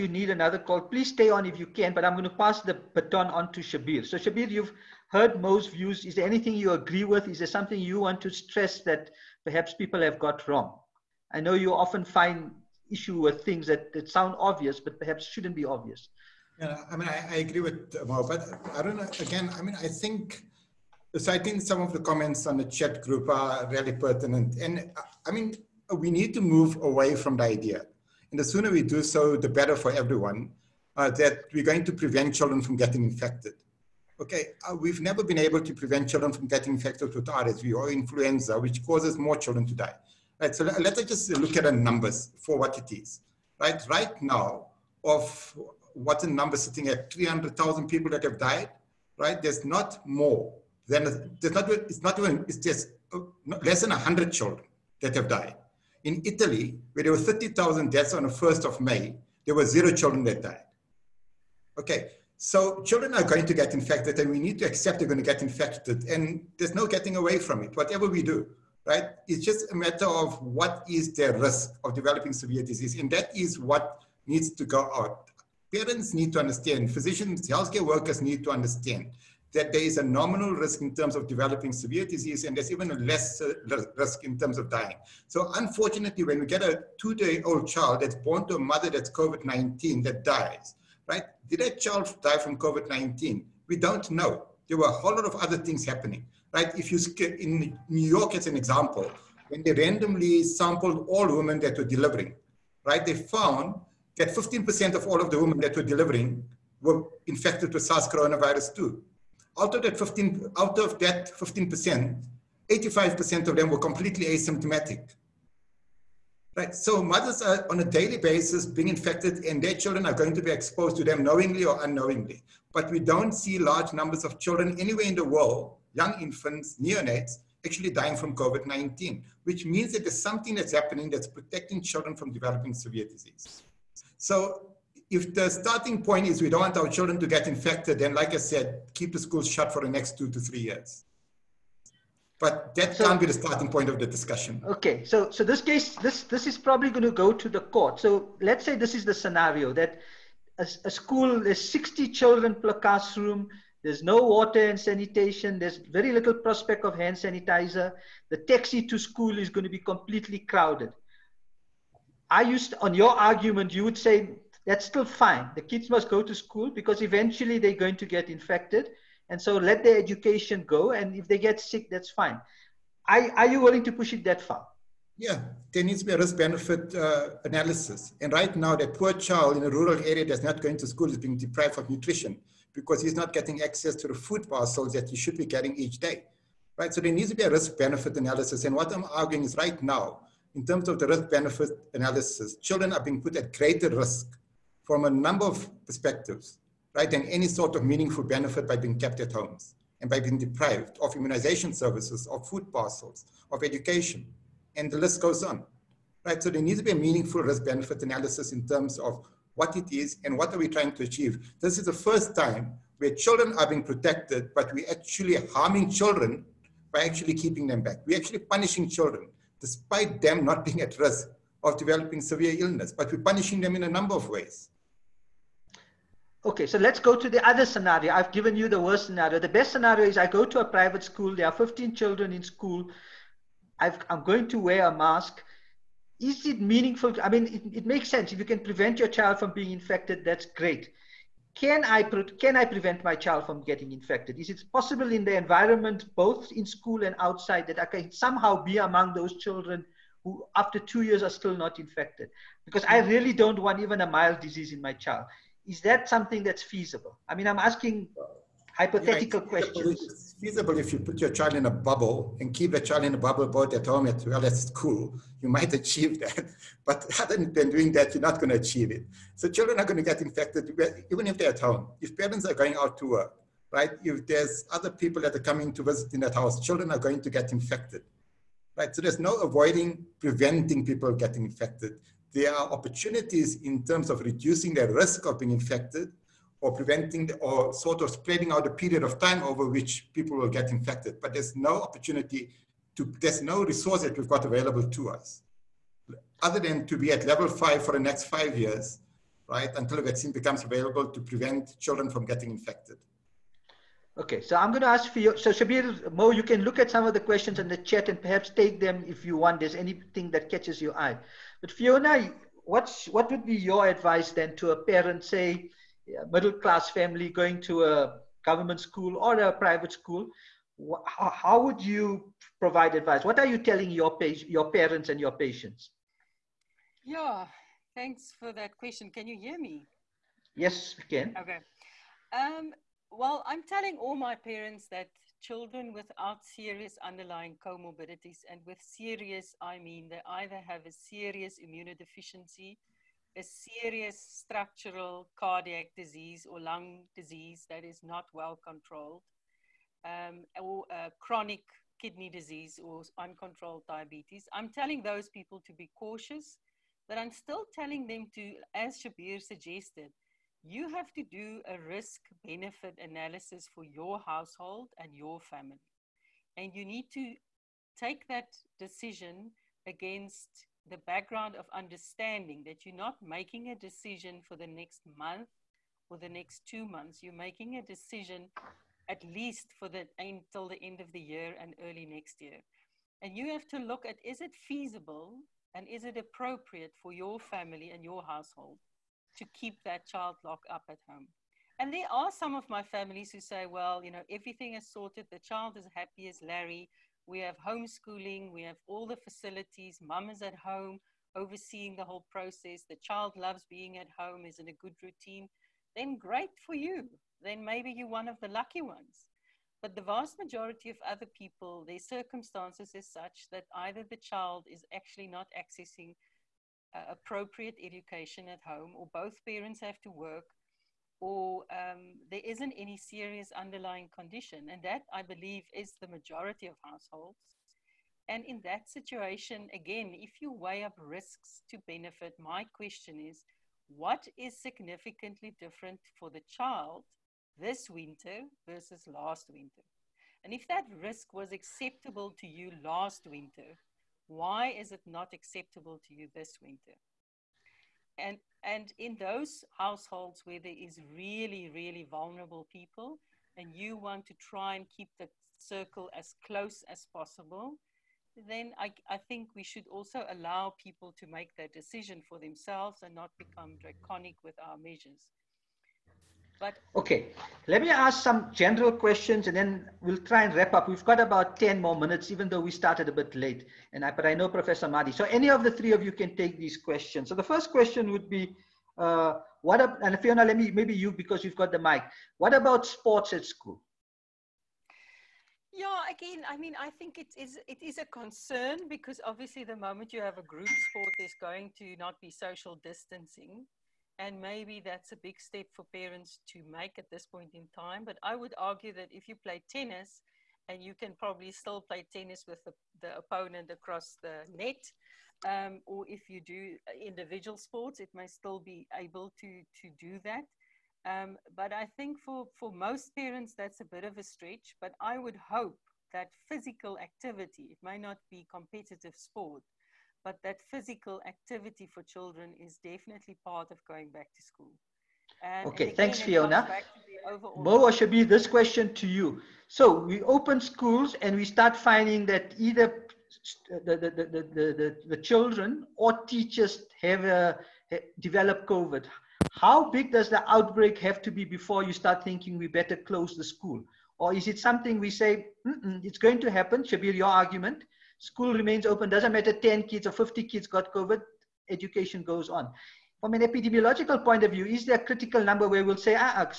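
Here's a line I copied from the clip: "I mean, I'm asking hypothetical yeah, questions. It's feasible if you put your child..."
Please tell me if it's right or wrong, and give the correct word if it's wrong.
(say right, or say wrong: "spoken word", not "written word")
right.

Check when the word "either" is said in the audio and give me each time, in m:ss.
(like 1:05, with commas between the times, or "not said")
5:40, 6:53, 8:52.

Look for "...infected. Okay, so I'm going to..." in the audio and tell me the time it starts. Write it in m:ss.
5:02.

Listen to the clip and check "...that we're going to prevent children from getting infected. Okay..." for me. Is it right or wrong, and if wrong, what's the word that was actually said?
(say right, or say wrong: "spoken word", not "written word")
right.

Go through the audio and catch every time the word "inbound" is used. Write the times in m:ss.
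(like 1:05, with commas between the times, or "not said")
not said.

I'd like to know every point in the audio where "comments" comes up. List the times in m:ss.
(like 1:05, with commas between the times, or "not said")
0:21.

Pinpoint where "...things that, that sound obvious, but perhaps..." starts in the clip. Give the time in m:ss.
0:13.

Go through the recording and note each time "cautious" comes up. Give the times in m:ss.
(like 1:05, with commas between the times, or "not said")
5:55.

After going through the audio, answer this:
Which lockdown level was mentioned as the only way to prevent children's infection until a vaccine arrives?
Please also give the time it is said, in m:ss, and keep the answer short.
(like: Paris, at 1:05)
level five, at 4:57.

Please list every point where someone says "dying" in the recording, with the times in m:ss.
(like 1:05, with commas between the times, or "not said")
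1:24, 2:07.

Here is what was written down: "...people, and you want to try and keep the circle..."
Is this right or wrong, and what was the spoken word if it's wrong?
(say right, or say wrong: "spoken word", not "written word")
right.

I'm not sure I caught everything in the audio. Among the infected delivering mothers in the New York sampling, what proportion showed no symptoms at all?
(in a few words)
85%.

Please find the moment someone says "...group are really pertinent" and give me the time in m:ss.
0:23.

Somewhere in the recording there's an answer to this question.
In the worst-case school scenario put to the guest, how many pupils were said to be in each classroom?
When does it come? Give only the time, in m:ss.
2:31.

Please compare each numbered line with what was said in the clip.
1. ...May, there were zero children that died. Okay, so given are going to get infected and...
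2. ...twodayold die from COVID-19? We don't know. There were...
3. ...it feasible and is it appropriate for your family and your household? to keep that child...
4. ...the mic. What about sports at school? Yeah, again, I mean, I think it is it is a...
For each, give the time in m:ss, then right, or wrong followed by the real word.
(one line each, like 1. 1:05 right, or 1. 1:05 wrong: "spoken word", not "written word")
1. 0:58 wrong: "children", not "given"
2. 1:31 wrong: "child", not "twodayold"
3. 6:24 right
4. 8:01 right.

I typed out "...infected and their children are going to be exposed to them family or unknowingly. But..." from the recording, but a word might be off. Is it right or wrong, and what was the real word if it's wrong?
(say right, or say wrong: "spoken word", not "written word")
wrong: "knowingly", not "family".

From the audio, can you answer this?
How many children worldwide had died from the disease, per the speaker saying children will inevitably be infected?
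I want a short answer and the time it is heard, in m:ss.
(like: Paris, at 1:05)
less than 100, at 0:53.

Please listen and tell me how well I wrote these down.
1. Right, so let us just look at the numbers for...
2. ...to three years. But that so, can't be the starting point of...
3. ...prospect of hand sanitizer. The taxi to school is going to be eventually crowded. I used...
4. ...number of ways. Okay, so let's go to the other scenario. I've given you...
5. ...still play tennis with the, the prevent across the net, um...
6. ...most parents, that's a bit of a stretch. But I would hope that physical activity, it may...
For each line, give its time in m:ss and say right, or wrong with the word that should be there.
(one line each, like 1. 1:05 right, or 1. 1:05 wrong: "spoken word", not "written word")
1. 0:40 right
2. 2:20 right
3. 2:36 wrong: "completely", not "eventually"
4. 3:43 right
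5. 8:21 wrong: "opponent", not "prevent"
6. 8:32 right.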